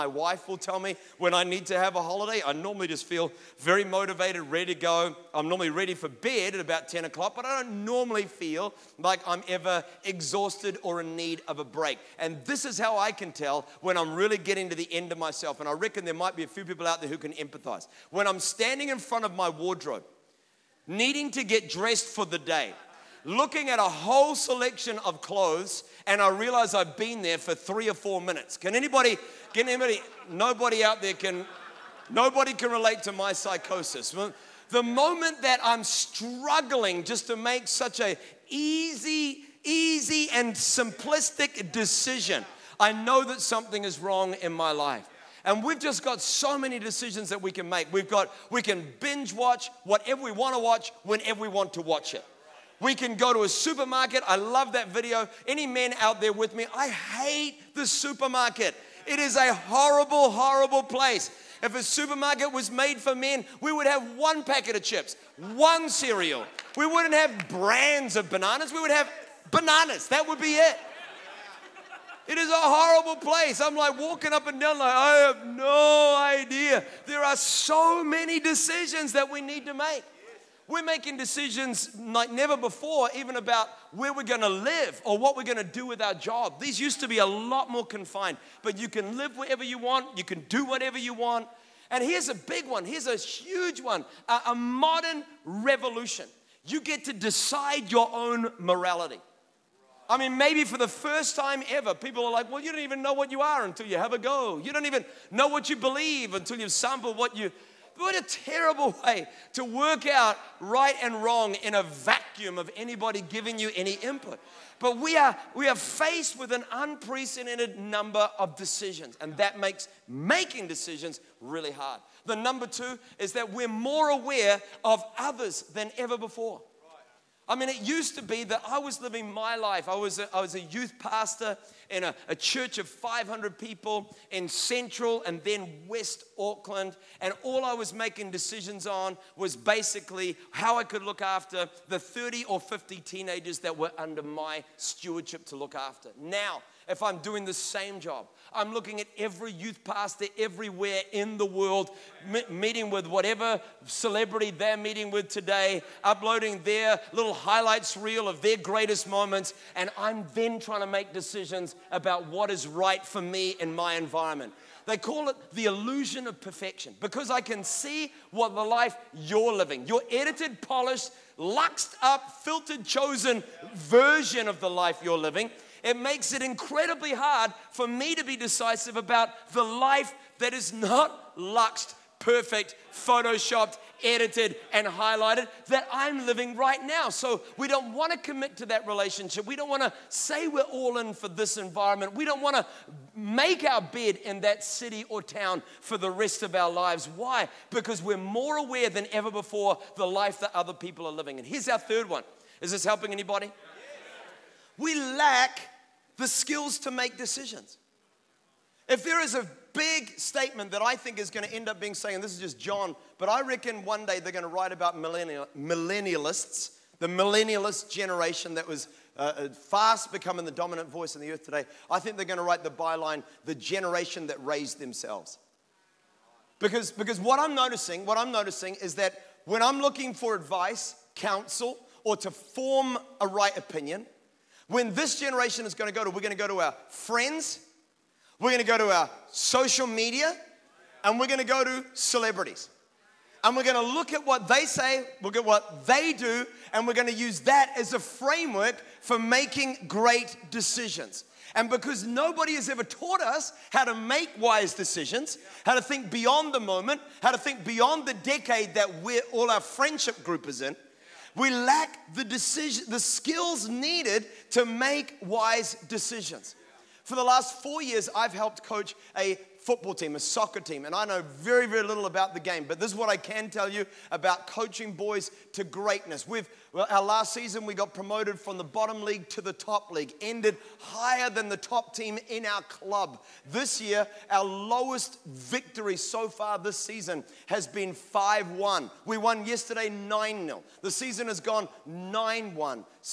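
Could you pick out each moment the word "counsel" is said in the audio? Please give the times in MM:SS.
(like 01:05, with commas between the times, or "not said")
03:51.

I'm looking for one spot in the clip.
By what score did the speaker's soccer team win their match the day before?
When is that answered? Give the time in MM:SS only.
04:49.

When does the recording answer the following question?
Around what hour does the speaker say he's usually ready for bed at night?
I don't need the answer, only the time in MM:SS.
00:06.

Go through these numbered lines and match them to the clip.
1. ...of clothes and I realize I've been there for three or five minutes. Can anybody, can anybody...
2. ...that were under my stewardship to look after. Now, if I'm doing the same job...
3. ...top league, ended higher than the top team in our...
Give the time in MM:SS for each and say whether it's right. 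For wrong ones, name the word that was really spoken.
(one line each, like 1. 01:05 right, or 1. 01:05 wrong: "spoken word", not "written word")
1. 00:25 wrong: "four", not "five"
2. 02:23 right
3. 04:39 right.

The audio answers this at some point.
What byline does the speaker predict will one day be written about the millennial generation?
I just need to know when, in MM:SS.
03:43.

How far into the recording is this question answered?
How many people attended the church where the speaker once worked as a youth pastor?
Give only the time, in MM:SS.
02:12.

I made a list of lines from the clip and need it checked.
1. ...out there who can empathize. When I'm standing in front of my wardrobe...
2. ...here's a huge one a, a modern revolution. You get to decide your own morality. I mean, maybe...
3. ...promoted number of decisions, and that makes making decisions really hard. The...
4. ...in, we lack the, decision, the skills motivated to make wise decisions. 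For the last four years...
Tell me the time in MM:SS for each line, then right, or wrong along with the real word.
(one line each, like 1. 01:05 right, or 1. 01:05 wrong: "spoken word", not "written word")
1. 00:16 right
2. 01:32 right
3. 01:56 wrong: "unprecedented", not "promoted"
4. 04:20 wrong: "needed", not "motivated".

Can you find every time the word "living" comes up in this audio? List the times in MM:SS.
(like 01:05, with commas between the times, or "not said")
02:09, 02:49, 02:55, 03:06, 03:21.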